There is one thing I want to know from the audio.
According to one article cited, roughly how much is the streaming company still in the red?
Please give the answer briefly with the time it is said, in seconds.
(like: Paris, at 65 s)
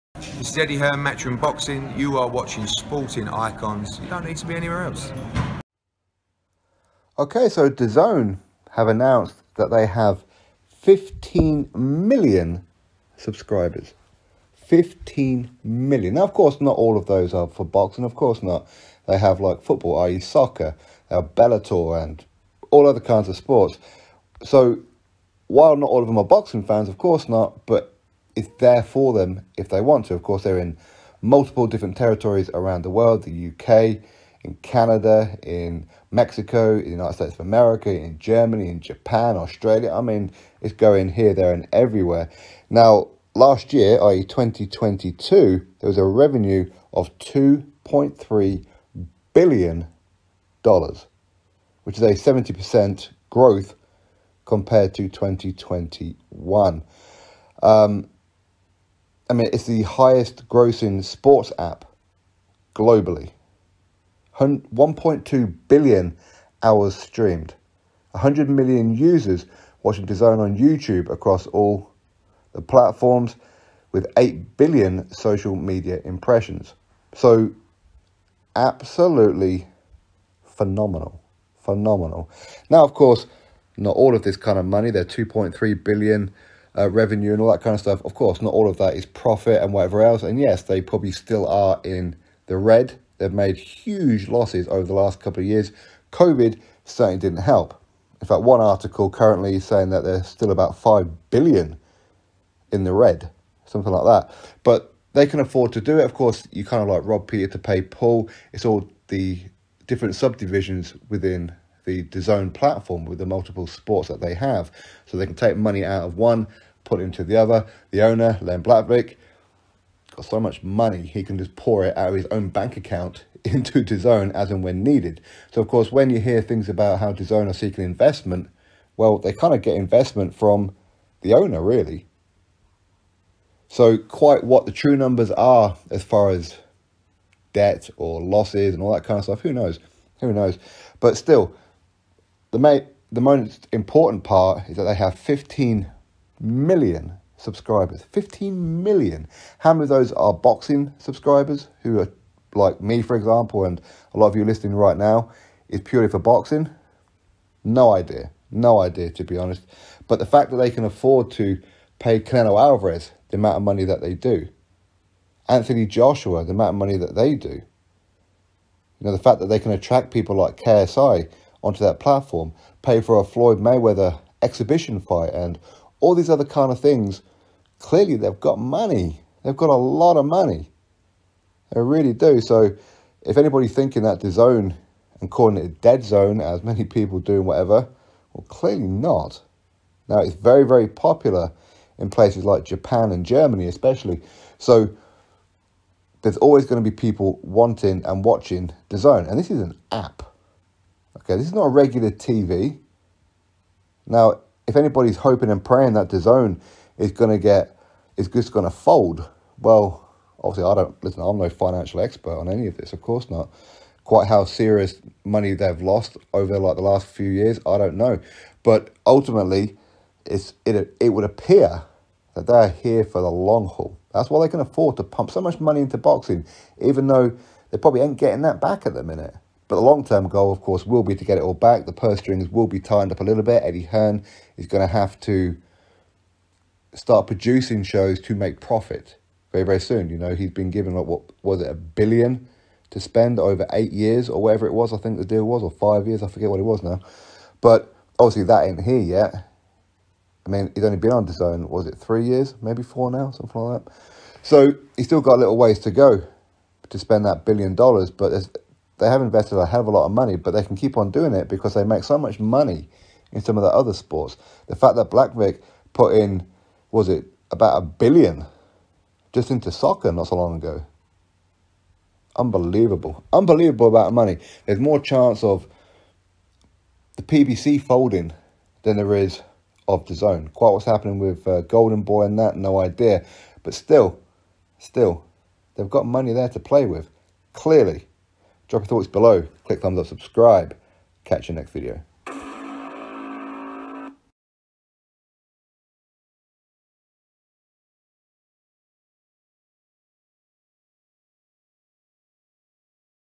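5 billion, at 100 s.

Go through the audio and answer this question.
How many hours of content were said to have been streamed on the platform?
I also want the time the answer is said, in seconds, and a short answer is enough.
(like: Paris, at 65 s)
1.2 billion, at 64 s.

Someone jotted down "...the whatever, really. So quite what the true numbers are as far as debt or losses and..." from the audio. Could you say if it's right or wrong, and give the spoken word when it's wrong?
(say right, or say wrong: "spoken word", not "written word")
wrong: "owner", not "whatever".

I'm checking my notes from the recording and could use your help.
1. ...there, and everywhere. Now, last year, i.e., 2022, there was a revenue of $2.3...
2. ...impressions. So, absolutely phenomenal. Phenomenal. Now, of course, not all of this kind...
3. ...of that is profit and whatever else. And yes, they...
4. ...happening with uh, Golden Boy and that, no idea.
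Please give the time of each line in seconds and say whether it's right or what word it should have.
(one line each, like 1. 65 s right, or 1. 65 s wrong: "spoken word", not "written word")
1. 41 s right
2. 76 s right
3. 88 s right
4. 280 s right.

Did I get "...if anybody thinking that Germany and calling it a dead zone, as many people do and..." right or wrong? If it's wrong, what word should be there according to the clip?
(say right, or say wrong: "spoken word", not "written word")
wrong: "DAZN", not "Germany".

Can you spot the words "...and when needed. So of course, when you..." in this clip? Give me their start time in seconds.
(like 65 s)
124 s.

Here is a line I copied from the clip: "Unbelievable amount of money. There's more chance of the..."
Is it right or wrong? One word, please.
right.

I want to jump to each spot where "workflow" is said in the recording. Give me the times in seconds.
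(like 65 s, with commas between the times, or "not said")
not said.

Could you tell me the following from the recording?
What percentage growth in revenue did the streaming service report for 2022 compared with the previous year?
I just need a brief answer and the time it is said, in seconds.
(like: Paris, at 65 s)
70%, at 52 s.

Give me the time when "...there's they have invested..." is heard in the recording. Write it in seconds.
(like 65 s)
258 s.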